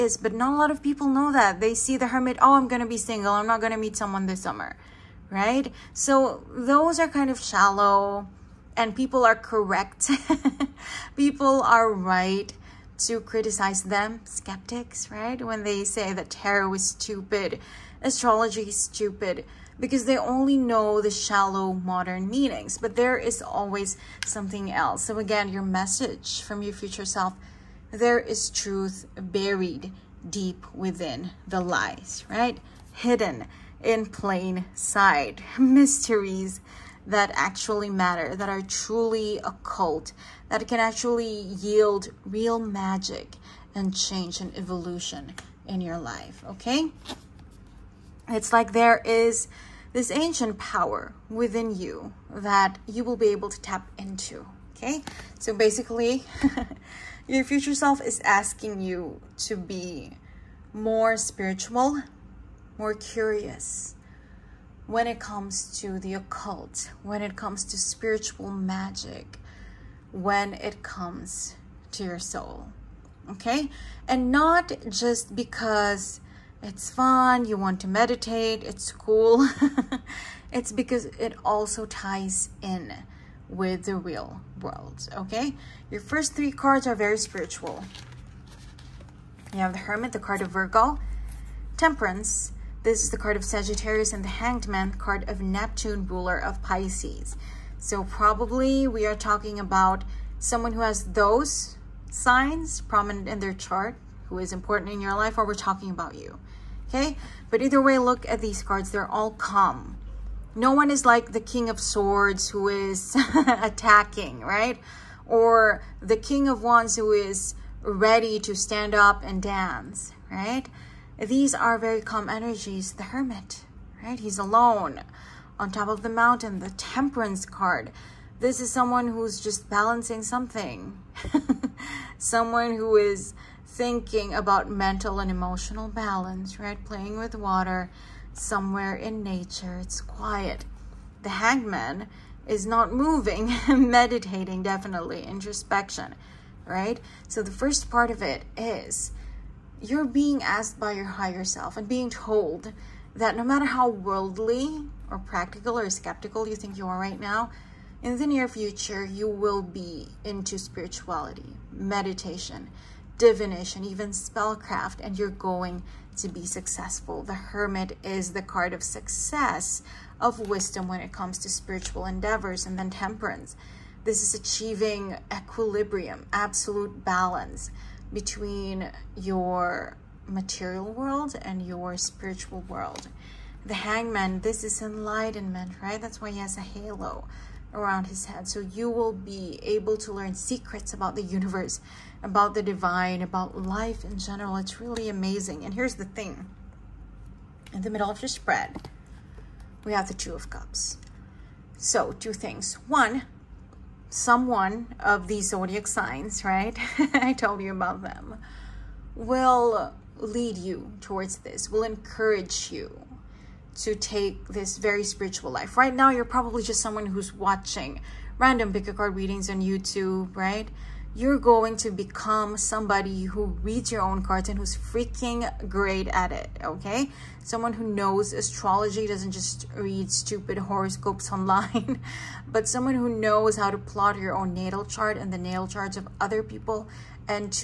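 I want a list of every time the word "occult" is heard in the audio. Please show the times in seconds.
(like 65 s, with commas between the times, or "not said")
39 s, 66 s.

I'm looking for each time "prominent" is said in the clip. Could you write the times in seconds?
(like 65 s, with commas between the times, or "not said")
102 s.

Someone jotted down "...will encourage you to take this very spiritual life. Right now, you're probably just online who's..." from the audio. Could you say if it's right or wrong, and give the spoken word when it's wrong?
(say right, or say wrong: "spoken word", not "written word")
wrong: "someone", not "online".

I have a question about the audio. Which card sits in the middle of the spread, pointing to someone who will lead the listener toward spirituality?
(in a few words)
Two of Cups.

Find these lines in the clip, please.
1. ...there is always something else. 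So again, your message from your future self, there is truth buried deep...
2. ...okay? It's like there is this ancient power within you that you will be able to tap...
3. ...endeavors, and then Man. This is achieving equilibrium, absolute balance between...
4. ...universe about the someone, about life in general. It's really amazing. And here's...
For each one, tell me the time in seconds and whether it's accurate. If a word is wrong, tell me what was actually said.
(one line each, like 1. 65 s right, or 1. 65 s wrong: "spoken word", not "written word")
1. 22 s right
2. 46 s right
3. 172 s wrong: "Temperance", not "Man"
4. 191 s wrong: "divine", not "someone".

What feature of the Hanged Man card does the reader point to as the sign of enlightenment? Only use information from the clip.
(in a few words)
A halo.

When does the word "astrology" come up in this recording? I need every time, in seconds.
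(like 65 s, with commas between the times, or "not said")
18 s, 228 s.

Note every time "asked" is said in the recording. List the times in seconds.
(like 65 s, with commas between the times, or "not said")
150 s.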